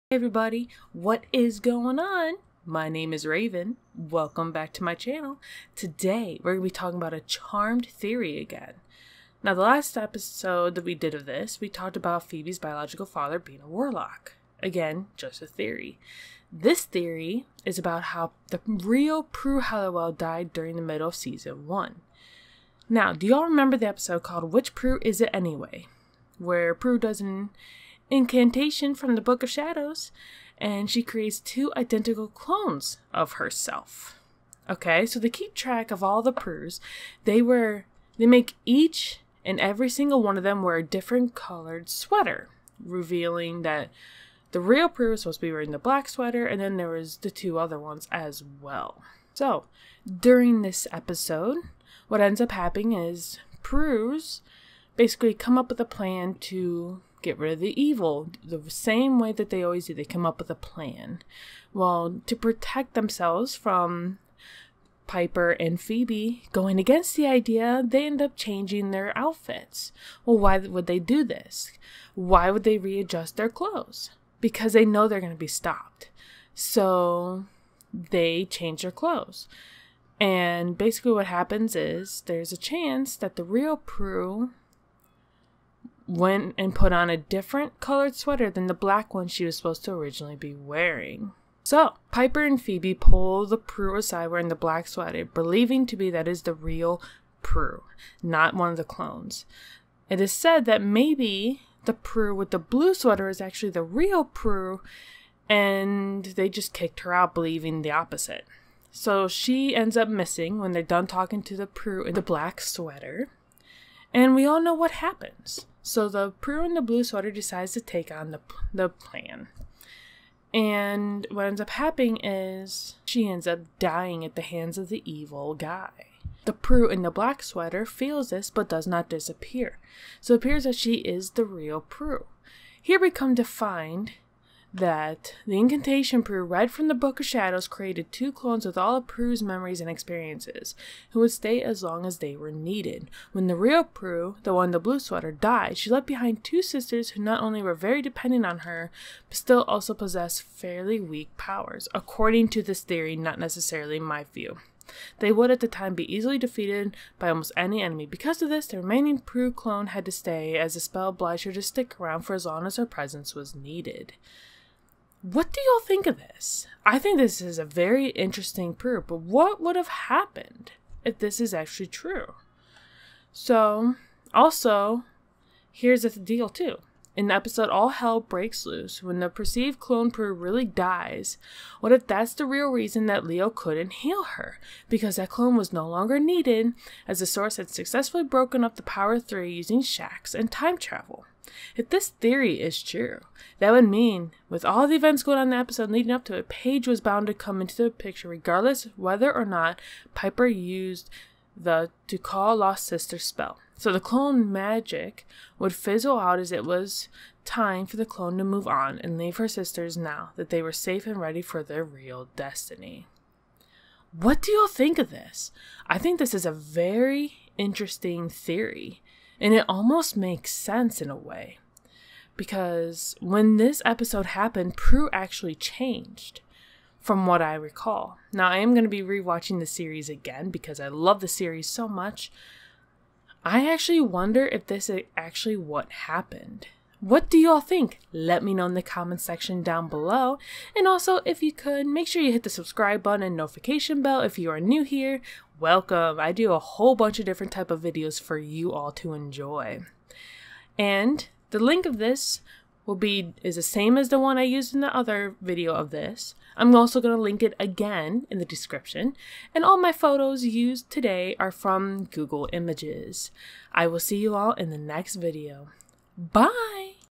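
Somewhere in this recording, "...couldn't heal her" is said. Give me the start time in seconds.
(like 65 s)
183 s.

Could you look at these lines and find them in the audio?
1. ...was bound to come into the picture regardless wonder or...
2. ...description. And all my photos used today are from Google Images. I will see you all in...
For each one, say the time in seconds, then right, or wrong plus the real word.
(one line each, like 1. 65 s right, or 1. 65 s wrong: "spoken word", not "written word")
1. 196 s wrong: "whether", not "wonder"
2. 258 s right.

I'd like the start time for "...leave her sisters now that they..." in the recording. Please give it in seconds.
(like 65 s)
209 s.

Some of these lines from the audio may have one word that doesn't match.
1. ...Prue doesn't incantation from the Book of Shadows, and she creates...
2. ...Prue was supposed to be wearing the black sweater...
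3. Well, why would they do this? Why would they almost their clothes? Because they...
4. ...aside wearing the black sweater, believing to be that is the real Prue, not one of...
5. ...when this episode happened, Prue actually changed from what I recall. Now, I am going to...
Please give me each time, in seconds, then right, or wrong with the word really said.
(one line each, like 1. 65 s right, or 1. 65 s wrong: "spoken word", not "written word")
1. 26 s right
2. 44 s right
3. 70 s wrong: "readjust", not "almost"
4. 93 s right
5. 223 s right.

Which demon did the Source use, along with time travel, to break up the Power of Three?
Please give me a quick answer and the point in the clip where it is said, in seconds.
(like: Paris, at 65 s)
Shax, at 189 s.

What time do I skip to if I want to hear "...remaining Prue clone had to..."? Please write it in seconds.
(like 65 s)
158 s.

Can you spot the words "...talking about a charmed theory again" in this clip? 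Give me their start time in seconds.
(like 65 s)
6 s.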